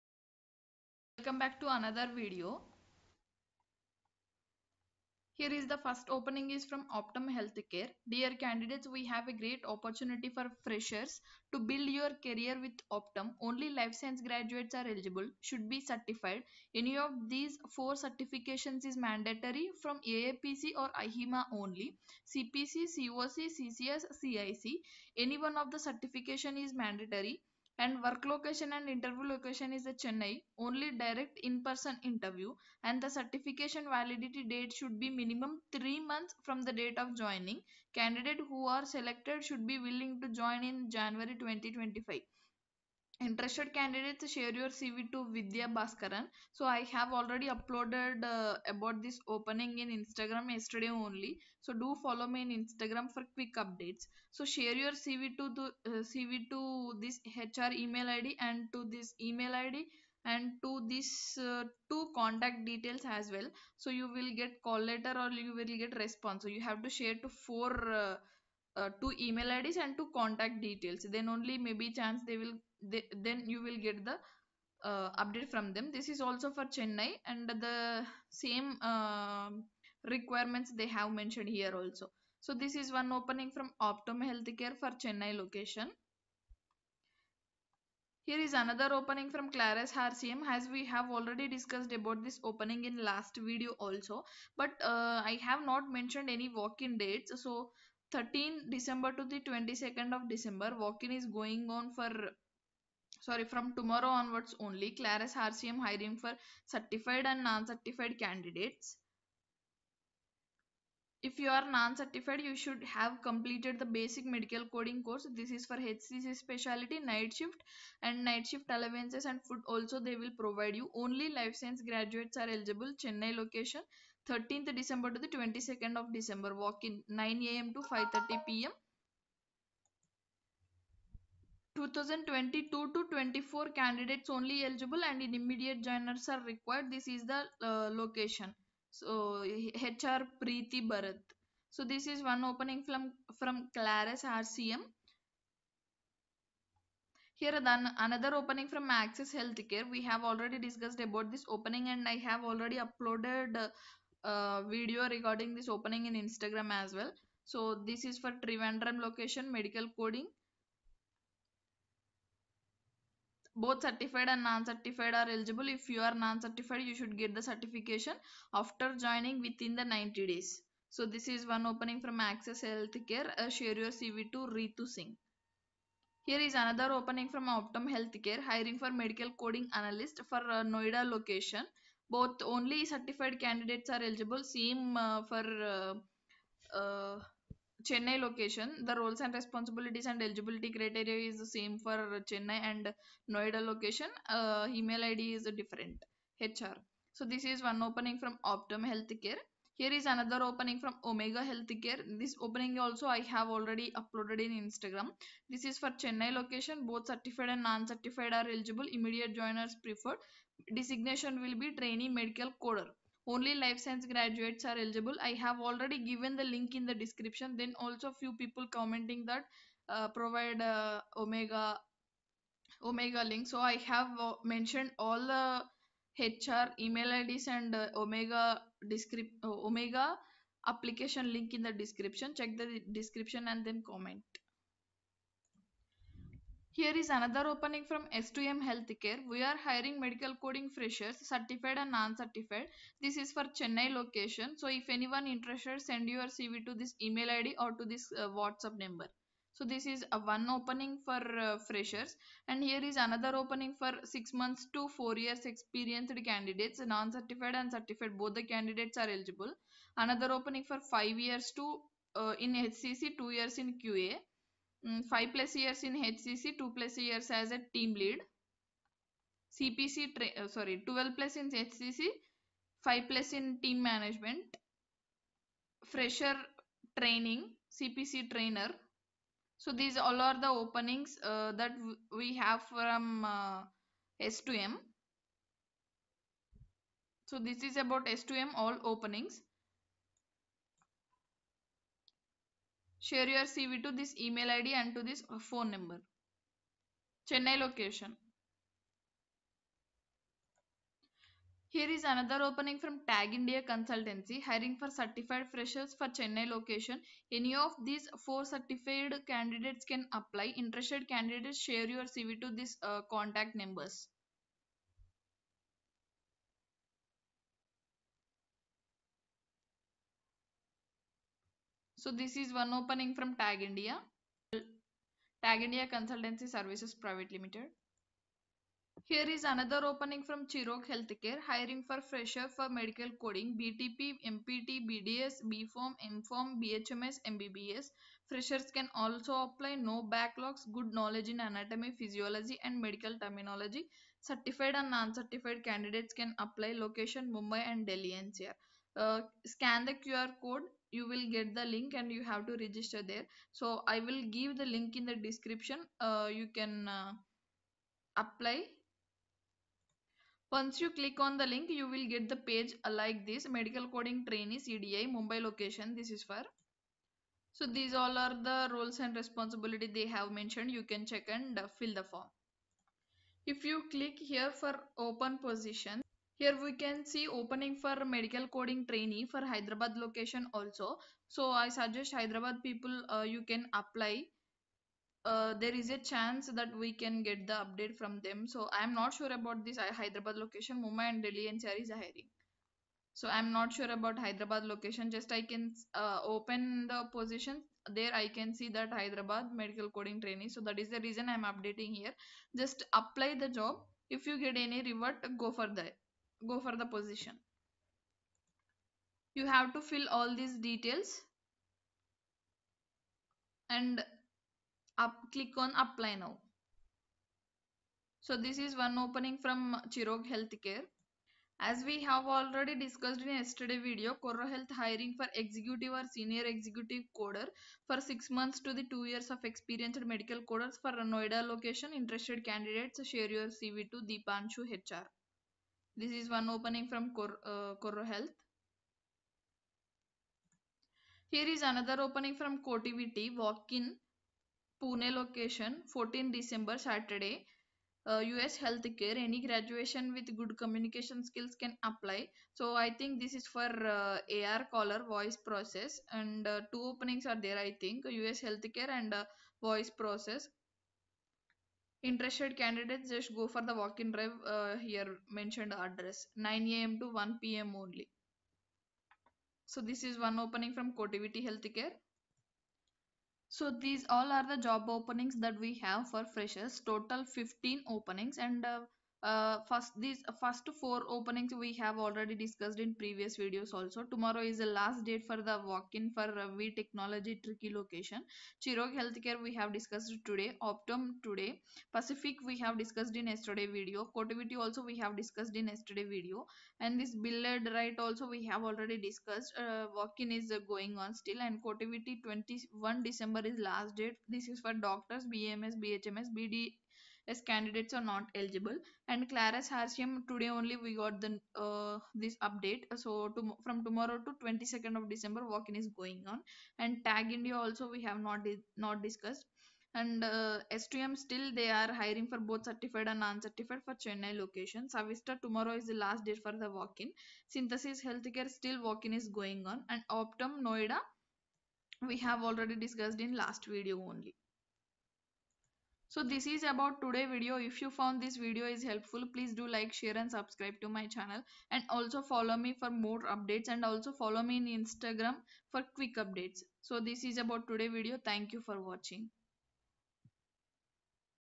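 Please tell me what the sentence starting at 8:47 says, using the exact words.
Synthesis Healthcare still walk-in is going on and Optum Noida we have already discussed in last video only.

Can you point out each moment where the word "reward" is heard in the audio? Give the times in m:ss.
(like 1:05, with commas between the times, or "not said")
6:44.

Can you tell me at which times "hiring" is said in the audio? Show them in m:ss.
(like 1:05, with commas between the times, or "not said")
1:45, 2:58, 3:59, 5:04, 5:31, 6:31, 7:04, 8:41.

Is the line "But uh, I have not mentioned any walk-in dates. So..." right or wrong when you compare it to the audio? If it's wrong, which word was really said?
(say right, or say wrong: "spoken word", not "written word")
right.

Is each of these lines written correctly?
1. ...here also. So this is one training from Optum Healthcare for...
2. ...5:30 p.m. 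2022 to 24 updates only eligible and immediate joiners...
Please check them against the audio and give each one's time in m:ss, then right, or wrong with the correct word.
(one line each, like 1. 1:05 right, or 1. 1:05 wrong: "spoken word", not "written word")
1. 1:21 wrong: "opening", not "training"
2. 2:07 wrong: "candidates", not "updates".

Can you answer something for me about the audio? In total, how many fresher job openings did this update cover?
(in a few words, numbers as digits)
15.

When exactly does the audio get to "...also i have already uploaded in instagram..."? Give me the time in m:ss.
3:22.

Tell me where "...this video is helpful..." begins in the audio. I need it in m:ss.
8:58.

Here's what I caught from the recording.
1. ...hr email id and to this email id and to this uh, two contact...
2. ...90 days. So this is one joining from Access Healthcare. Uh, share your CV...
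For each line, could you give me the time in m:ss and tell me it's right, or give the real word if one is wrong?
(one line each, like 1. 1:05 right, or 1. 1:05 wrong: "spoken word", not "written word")
1. 0:57 right
2. 2:49 wrong: "opening", not "joining".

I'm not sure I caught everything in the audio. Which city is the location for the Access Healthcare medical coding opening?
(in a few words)
Trivandrum.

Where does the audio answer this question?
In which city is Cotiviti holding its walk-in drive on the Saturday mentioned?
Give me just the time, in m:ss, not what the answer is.
7:24.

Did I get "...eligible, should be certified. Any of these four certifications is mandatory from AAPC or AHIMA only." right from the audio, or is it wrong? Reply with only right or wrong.
right.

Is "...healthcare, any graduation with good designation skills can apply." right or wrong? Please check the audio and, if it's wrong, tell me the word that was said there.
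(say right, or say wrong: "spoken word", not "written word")
wrong: "communication", not "designation".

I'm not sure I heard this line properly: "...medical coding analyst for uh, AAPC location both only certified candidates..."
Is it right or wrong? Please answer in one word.
wrong.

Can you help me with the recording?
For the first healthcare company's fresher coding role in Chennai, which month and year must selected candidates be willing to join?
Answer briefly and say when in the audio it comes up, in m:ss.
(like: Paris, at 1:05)
January 2025, at 0:40.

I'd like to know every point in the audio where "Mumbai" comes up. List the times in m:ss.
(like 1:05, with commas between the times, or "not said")
5:47, 6:05, 6:30.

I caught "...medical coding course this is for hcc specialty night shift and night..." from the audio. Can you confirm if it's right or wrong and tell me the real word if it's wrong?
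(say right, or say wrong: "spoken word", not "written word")
right.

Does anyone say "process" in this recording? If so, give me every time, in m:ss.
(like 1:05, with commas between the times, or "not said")
7:35, 7:39.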